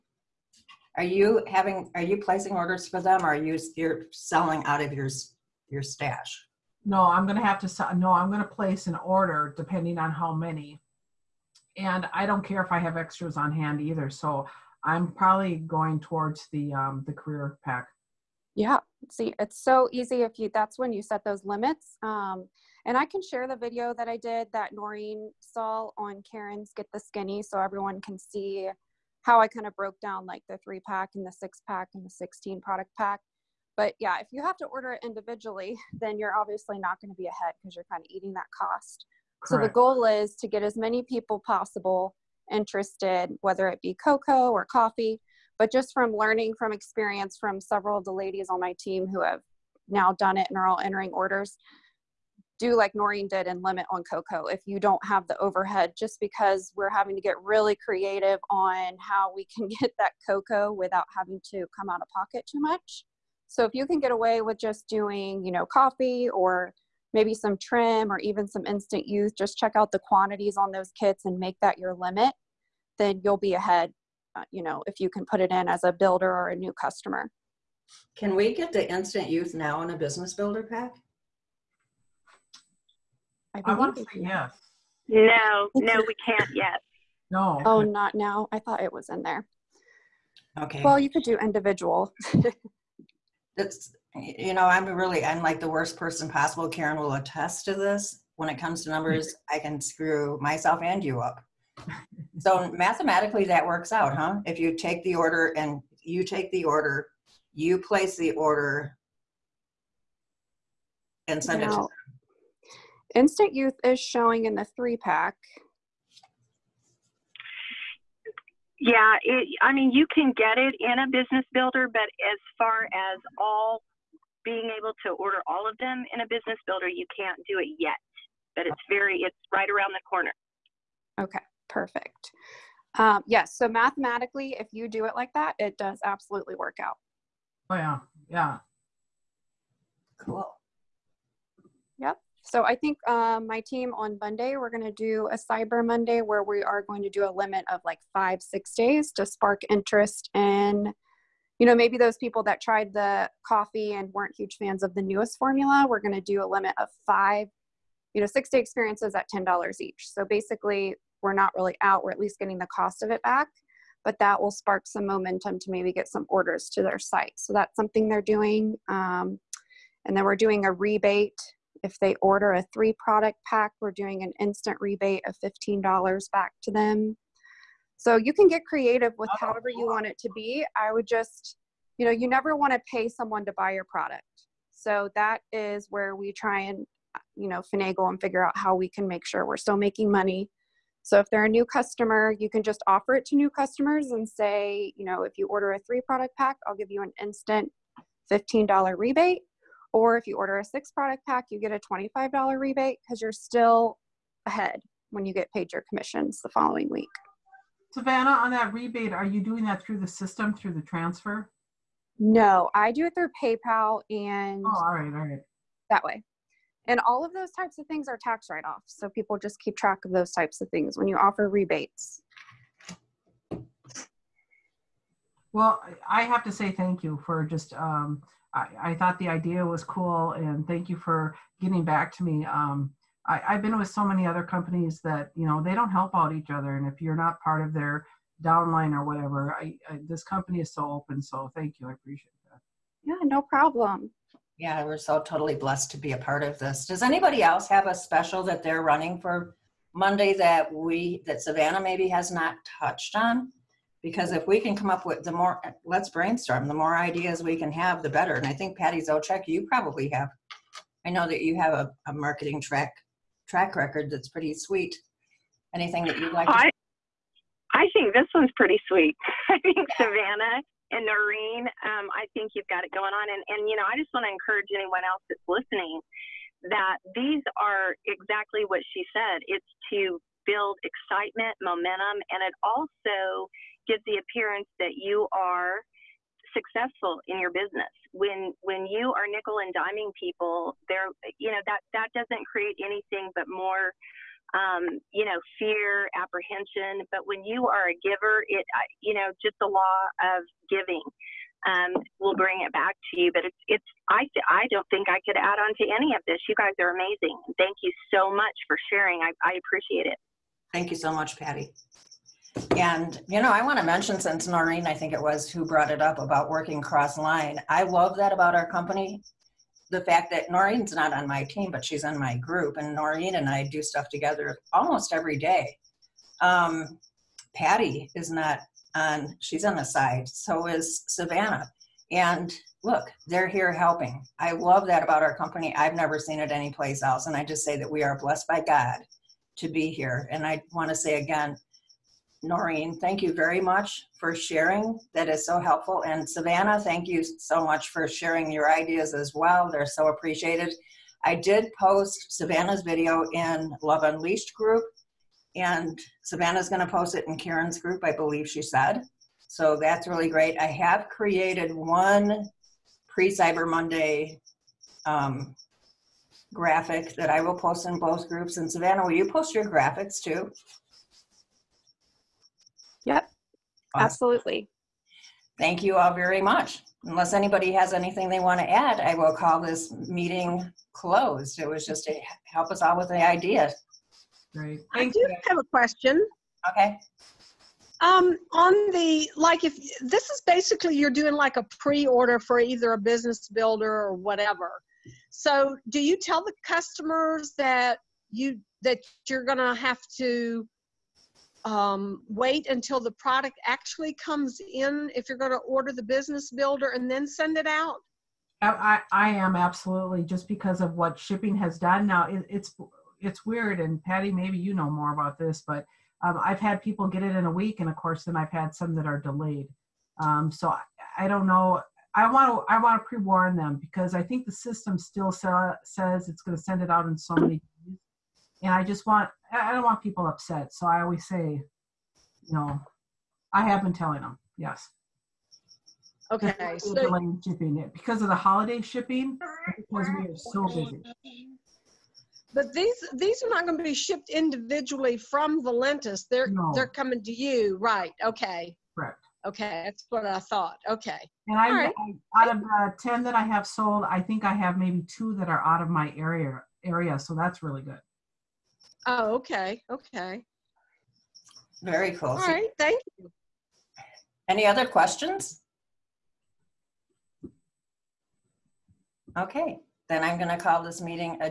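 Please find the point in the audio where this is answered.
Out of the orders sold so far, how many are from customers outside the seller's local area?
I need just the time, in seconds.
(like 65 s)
455 s.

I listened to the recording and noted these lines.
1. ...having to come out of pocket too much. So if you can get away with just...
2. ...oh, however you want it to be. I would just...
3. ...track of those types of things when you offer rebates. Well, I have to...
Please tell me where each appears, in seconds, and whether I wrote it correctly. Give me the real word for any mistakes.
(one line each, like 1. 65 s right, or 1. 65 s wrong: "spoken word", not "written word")
1. 61 s right
2. 179 s right
3. 219 s right.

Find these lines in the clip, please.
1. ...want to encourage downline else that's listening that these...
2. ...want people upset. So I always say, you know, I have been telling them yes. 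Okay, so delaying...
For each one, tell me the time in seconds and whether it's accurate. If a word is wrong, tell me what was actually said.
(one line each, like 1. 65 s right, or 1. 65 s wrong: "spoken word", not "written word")
1. 274 s wrong: "anyone", not "downline"
2. 429 s right.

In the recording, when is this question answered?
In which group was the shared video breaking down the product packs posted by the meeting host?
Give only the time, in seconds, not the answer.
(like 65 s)
353 s.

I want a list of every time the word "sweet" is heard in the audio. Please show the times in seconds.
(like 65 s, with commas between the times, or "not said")
264 s, 268 s.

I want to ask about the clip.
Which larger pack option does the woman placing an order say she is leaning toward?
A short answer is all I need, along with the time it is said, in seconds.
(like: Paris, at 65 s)
career pack, at 17 s.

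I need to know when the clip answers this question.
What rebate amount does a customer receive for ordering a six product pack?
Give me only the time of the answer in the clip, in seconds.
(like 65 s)
201 s.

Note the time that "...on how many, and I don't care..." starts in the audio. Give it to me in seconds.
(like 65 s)
9 s.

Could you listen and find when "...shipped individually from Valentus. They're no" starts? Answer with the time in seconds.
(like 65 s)
443 s.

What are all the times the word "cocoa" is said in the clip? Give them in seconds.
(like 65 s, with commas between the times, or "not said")
44 s, 54 s, 60 s.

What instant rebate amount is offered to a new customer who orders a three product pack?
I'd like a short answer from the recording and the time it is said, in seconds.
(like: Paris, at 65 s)
$15, at 175 s.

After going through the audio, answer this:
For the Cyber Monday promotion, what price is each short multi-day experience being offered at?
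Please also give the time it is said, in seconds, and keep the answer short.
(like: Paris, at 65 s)
$10, at 159 s.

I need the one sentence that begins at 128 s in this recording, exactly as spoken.
But it's very, it's right around the corner.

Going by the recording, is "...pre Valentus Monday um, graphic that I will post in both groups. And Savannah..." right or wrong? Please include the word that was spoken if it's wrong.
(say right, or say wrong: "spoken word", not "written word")
wrong: "Cyber", not "Valentus".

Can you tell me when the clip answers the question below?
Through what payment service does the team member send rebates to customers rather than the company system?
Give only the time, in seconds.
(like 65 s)
213 s.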